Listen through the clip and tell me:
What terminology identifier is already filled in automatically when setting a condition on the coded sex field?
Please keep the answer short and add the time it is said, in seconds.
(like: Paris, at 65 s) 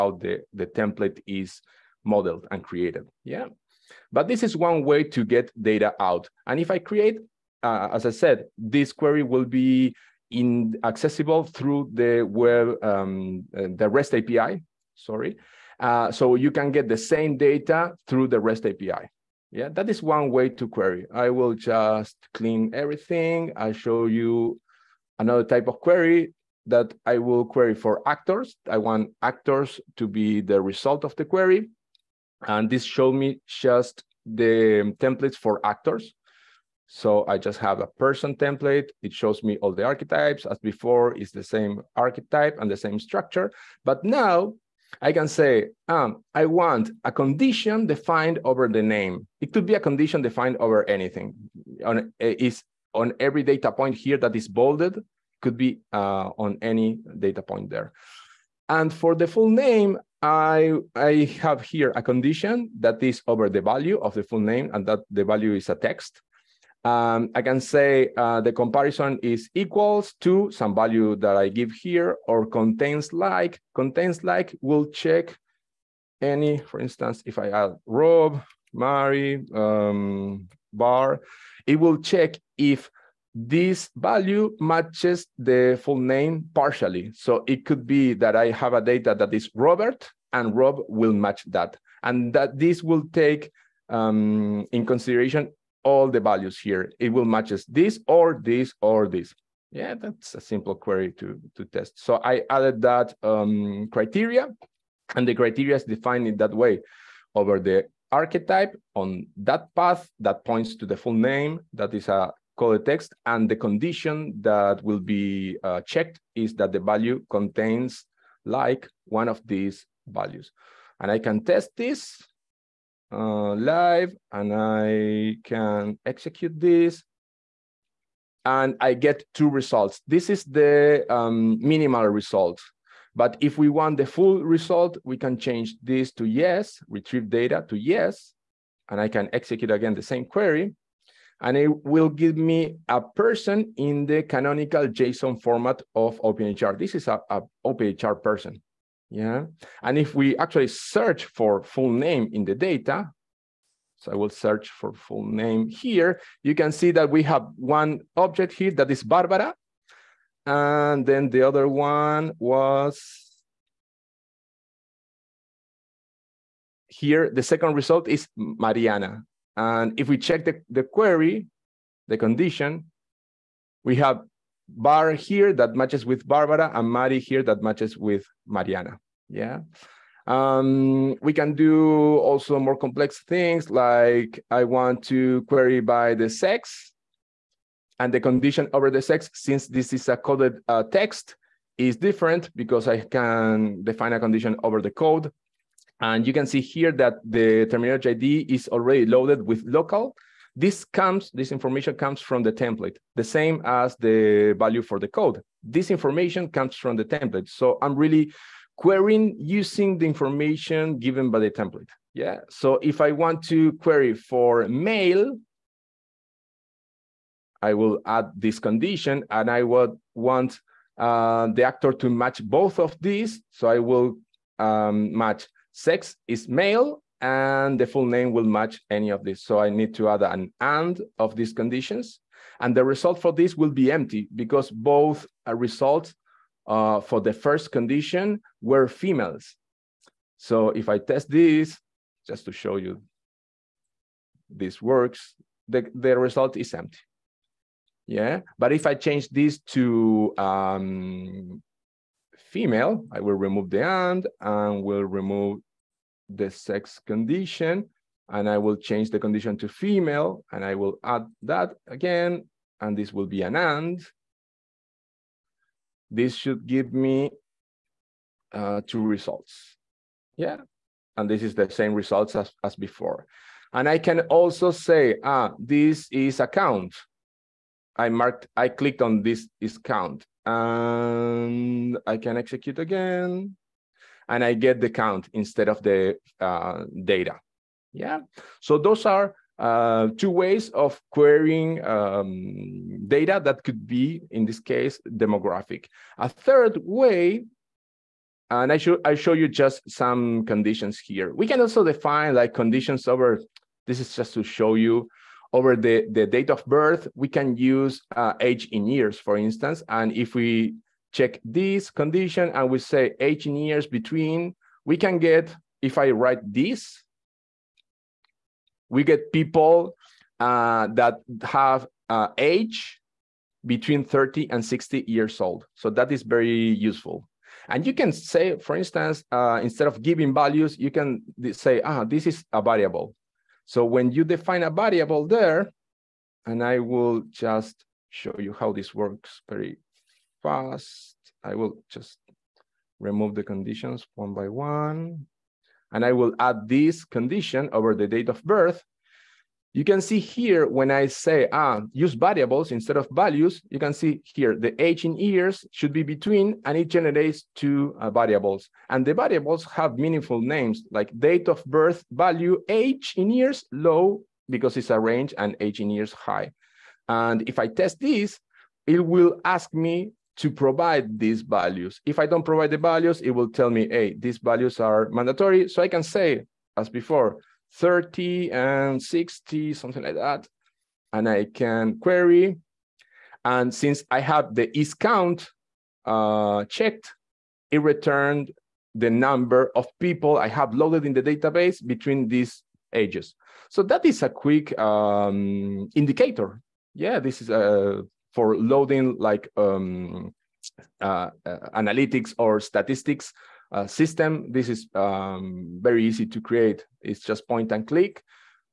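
local, at 199 s.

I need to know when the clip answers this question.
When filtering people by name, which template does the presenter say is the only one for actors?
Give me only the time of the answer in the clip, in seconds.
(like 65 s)
38 s.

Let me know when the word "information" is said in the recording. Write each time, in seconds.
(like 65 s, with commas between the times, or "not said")
201 s, 205 s, 210 s.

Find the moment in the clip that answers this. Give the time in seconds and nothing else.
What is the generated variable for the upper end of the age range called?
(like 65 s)
365 s.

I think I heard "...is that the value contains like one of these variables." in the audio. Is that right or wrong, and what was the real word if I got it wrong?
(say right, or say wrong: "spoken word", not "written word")
wrong: "values", not "variables".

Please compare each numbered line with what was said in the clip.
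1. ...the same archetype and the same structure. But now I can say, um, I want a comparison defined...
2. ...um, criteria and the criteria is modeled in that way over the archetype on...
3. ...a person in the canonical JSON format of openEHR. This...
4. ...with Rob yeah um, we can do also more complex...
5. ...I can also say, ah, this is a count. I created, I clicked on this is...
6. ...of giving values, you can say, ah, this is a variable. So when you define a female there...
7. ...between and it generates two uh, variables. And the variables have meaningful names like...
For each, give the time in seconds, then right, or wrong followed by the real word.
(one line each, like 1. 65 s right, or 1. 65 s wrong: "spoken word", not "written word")
1. 41 s wrong: "condition", not "comparison"
2. 103 s wrong: "defined", not "modeled"
3. 142 s right
4. 177 s wrong: "Mariana", not "Rob"
5. 273 s wrong: "marked", not "created"
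6. 329 s wrong: "variable", not "female"
7. 356 s right.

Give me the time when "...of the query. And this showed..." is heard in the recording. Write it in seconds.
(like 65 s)
31 s.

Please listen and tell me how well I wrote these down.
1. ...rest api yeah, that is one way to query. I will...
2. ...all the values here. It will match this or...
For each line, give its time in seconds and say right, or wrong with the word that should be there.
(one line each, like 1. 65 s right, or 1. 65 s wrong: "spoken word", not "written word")
1. 18 s right
2. 95 s right.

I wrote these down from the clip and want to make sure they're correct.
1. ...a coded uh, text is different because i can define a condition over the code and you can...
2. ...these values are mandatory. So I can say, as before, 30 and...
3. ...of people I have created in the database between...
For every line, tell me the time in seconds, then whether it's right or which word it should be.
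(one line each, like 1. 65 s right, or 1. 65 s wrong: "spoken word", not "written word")
1. 190 s right
2. 374 s right
3. 389 s wrong: "loaded", not "created".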